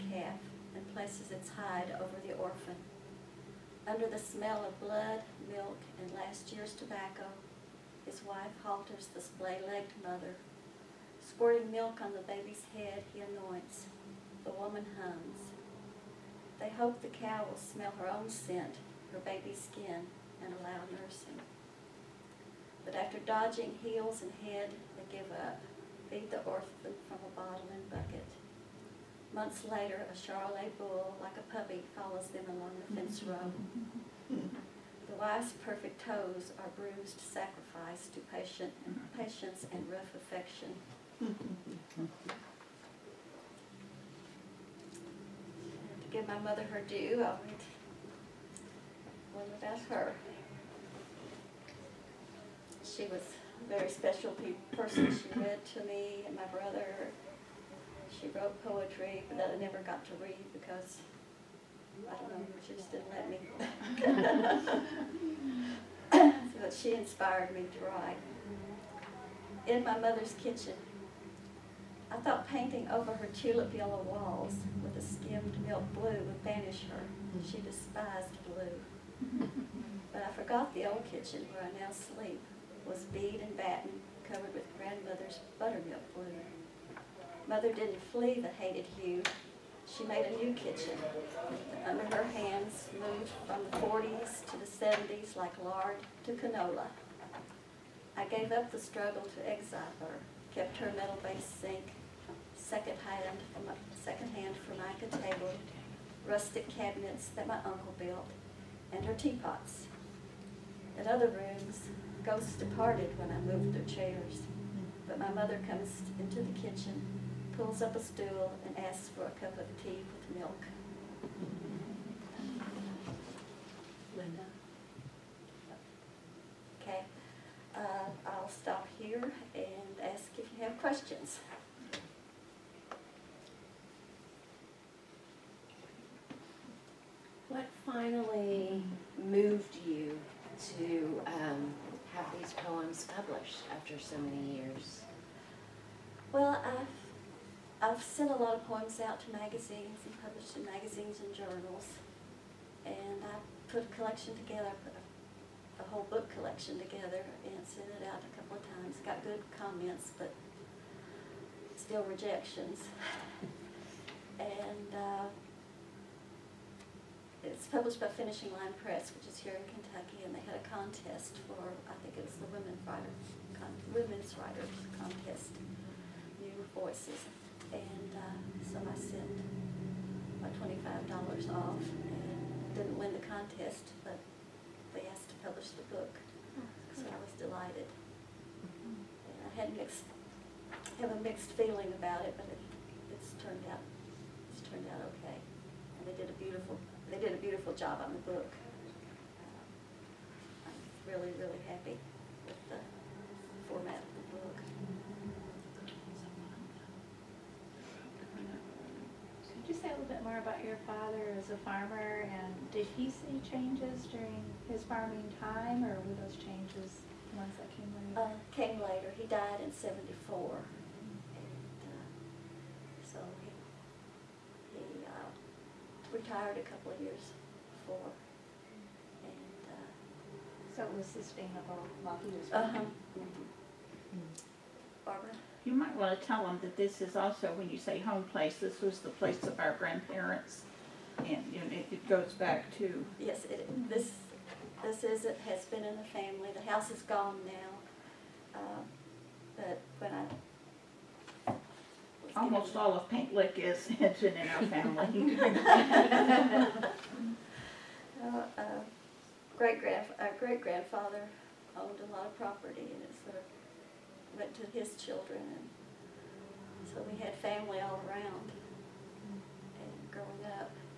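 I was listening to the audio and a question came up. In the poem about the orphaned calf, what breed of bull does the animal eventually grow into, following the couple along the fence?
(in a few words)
Charolais.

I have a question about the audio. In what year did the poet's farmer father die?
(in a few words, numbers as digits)
1974.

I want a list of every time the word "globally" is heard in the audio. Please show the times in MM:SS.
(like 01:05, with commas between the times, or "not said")
not said.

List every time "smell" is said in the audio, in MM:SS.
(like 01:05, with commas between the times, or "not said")
00:04, 00:17.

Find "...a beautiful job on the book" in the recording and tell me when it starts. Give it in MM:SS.
03:17.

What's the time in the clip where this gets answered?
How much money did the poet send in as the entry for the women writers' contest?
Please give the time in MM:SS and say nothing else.
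03:00.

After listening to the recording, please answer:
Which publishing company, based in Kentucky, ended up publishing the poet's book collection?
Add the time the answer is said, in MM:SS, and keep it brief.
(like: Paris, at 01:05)
Finishing Line Press, at 02:48.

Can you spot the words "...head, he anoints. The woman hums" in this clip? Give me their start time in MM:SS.
00:12.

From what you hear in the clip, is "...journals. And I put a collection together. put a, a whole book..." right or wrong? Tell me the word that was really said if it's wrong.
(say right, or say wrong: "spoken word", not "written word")
right.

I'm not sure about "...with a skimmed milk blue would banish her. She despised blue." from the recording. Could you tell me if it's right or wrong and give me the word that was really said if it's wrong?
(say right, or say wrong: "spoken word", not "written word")
right.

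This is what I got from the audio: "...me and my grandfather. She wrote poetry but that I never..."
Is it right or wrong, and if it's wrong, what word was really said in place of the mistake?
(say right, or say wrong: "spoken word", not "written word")
wrong: "brother", not "grandfather".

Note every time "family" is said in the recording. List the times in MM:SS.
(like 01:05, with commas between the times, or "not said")
04:06, 04:14, 04:27.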